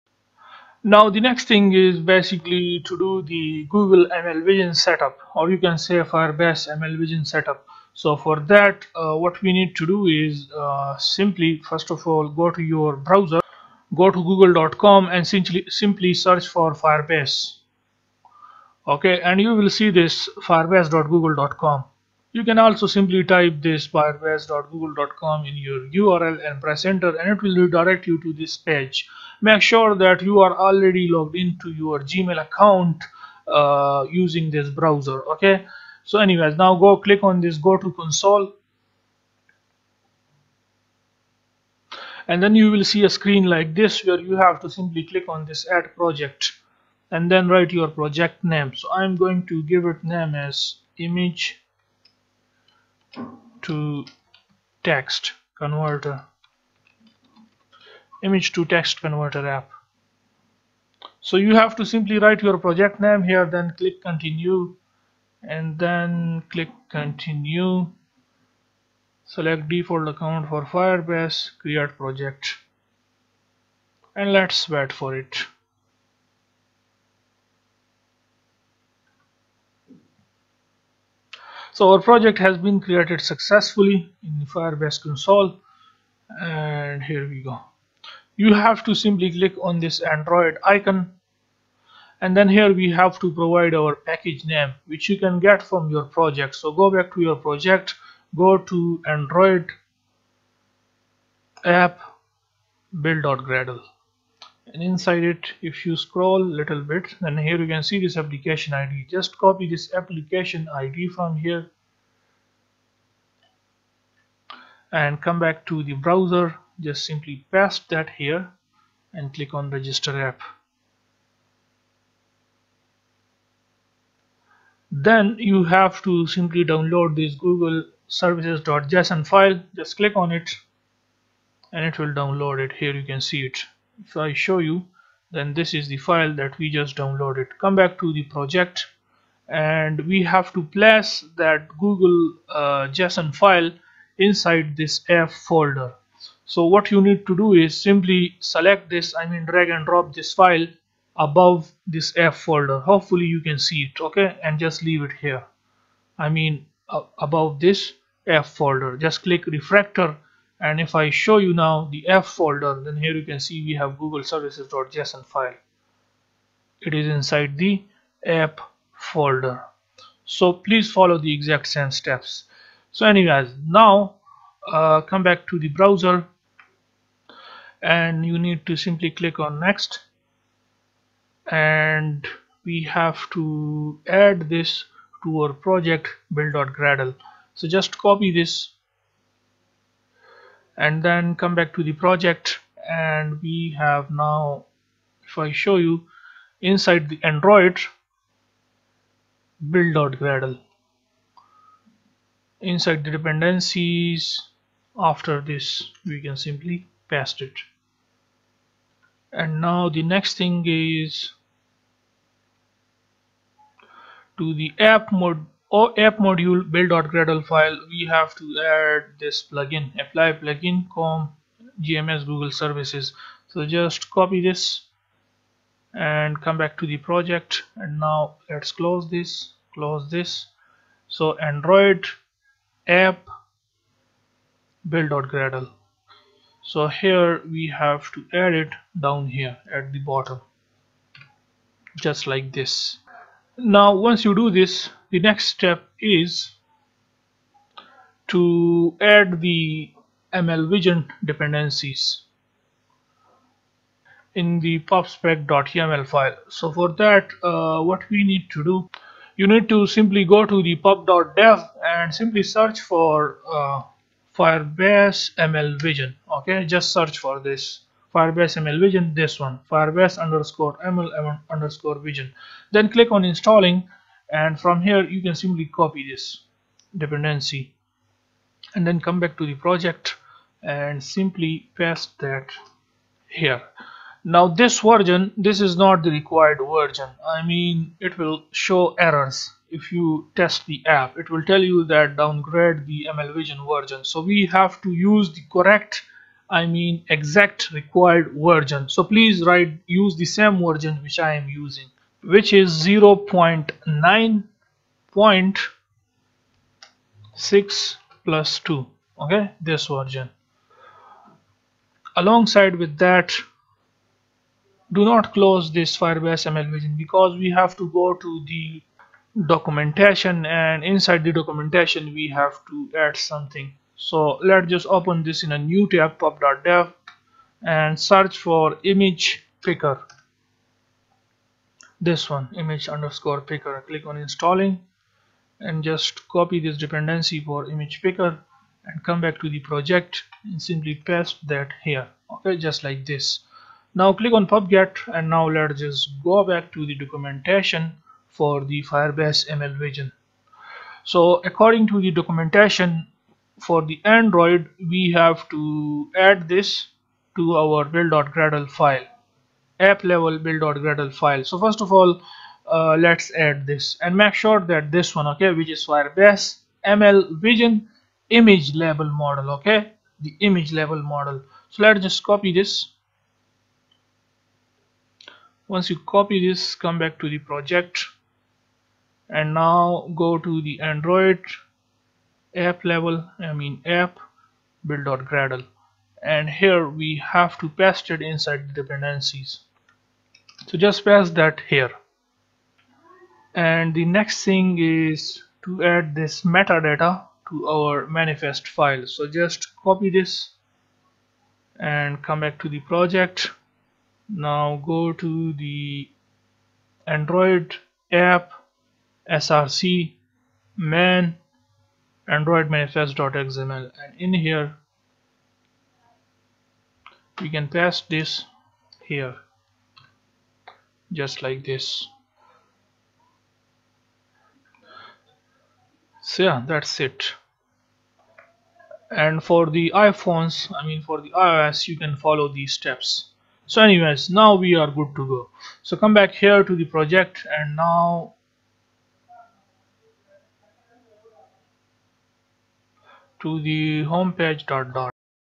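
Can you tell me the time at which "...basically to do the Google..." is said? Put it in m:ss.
0:01.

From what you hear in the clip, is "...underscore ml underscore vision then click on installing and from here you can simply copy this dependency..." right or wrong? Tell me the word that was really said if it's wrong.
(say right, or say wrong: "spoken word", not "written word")
right.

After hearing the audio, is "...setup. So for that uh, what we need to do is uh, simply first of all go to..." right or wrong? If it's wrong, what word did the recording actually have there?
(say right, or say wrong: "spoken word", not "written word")
right.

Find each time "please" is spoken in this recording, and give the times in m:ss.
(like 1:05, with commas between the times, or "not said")
2:50, 4:59.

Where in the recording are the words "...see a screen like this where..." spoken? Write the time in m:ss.
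0:42.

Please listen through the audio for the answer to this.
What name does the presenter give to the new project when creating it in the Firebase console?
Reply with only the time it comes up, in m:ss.
0:58.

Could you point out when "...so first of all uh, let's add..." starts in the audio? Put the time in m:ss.
6:01.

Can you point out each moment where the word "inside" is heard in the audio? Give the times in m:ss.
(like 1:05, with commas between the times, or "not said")
1:44, 2:24, 2:47, 3:16, 3:22, 5:20, 6:28.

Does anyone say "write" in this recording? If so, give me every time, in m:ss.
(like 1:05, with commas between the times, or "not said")
0:47, 1:02, 4:59.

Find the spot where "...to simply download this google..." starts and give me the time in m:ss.
2:06.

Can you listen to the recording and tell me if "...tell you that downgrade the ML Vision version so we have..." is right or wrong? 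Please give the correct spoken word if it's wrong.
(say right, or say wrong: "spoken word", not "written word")
right.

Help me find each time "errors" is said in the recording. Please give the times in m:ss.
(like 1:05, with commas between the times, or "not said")
4:48.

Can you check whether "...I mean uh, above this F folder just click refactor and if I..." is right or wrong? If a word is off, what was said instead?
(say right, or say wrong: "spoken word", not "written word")
right.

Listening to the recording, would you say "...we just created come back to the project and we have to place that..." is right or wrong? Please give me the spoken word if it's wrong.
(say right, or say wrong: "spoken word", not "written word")
wrong: "downloaded", not "created".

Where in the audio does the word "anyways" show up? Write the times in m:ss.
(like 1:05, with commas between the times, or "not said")
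0:36, 2:53, 7:13.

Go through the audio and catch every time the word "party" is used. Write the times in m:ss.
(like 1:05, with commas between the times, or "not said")
not said.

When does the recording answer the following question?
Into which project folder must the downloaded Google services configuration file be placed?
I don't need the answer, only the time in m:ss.
2:48.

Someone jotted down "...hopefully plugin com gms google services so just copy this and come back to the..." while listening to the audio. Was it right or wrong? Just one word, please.
wrong.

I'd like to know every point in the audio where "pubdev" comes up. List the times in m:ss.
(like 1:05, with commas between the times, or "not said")
4:20, 5:26.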